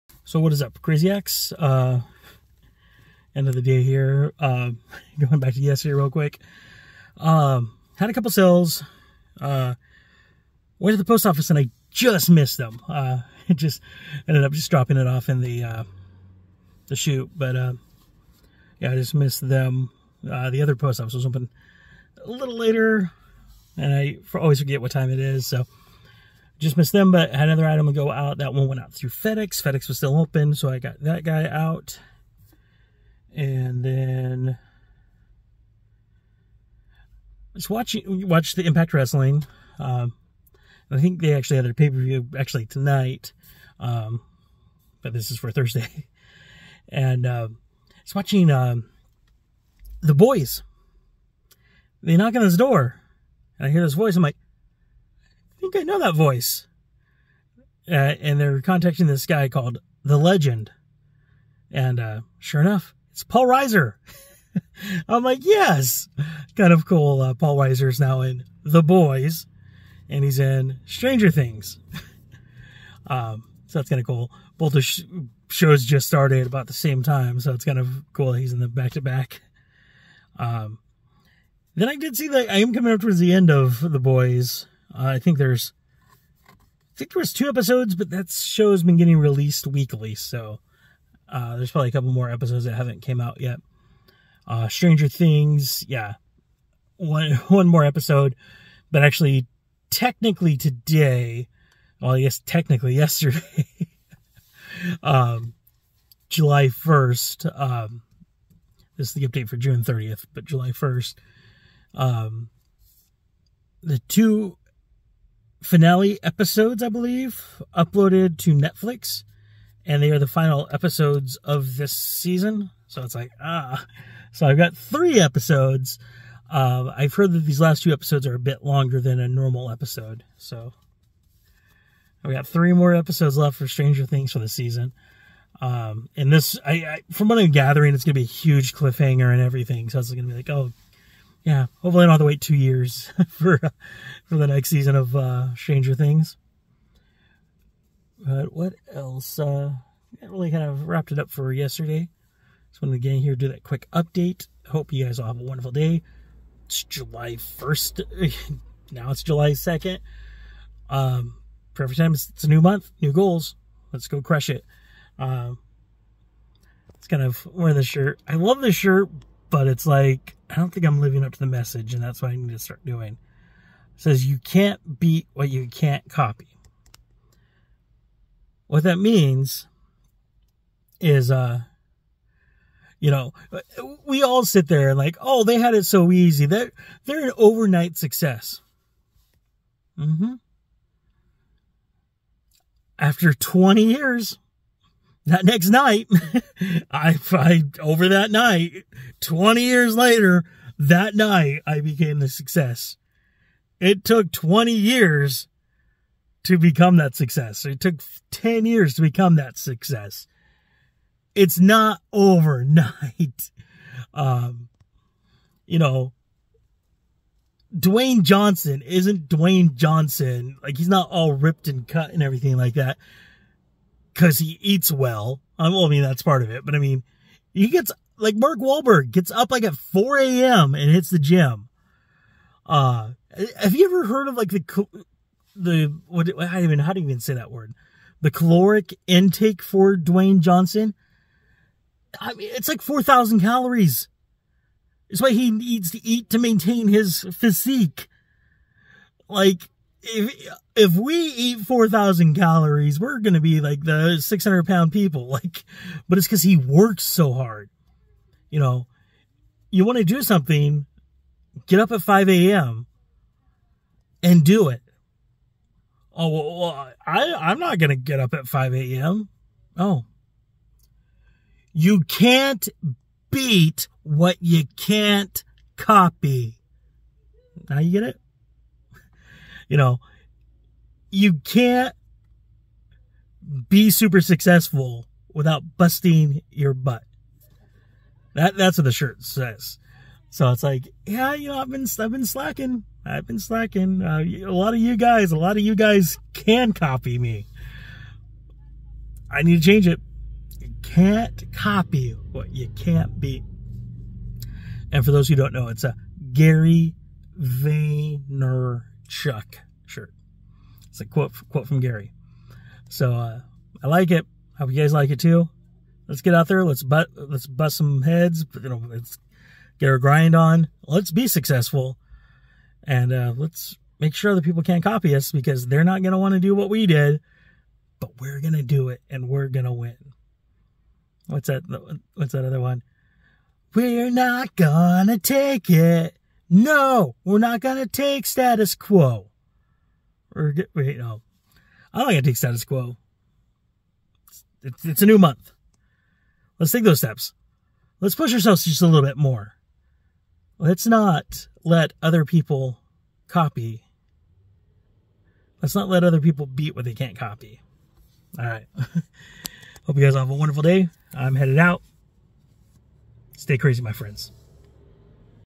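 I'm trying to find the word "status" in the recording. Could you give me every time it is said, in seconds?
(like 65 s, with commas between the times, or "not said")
338 s, 342 s.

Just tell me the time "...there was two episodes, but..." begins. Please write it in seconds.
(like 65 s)
87 s.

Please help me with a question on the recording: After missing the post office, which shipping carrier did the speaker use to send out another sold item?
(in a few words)
FedEx.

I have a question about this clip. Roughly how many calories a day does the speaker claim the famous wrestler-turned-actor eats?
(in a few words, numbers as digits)
4,000 calories.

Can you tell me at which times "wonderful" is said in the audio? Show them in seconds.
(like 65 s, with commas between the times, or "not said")
155 s, 360 s.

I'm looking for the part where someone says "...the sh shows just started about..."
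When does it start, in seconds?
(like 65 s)
74 s.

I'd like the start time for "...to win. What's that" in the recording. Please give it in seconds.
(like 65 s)
329 s.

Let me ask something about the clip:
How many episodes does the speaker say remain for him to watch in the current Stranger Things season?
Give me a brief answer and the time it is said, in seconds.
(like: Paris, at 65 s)
3, at 130 s.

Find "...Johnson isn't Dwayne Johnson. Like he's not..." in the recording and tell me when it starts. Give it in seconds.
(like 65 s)
218 s.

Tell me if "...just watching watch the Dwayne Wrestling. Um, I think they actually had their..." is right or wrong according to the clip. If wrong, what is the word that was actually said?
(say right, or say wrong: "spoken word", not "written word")
wrong: "Impact", not "Dwayne".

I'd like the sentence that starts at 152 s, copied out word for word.
Just wanted to get in here, do that quick update.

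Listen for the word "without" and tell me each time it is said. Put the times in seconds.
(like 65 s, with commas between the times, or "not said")
285 s.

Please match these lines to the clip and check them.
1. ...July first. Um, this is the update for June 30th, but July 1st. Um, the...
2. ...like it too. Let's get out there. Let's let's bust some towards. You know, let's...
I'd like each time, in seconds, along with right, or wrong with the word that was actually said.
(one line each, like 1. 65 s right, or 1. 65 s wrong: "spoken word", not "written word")
1. 106 s right
2. 314 s wrong: "heads", not "towards".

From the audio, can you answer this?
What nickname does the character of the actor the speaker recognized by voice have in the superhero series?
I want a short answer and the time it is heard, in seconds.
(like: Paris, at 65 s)
The Legend, at 59 s.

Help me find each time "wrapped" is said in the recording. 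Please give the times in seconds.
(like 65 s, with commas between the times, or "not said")
150 s.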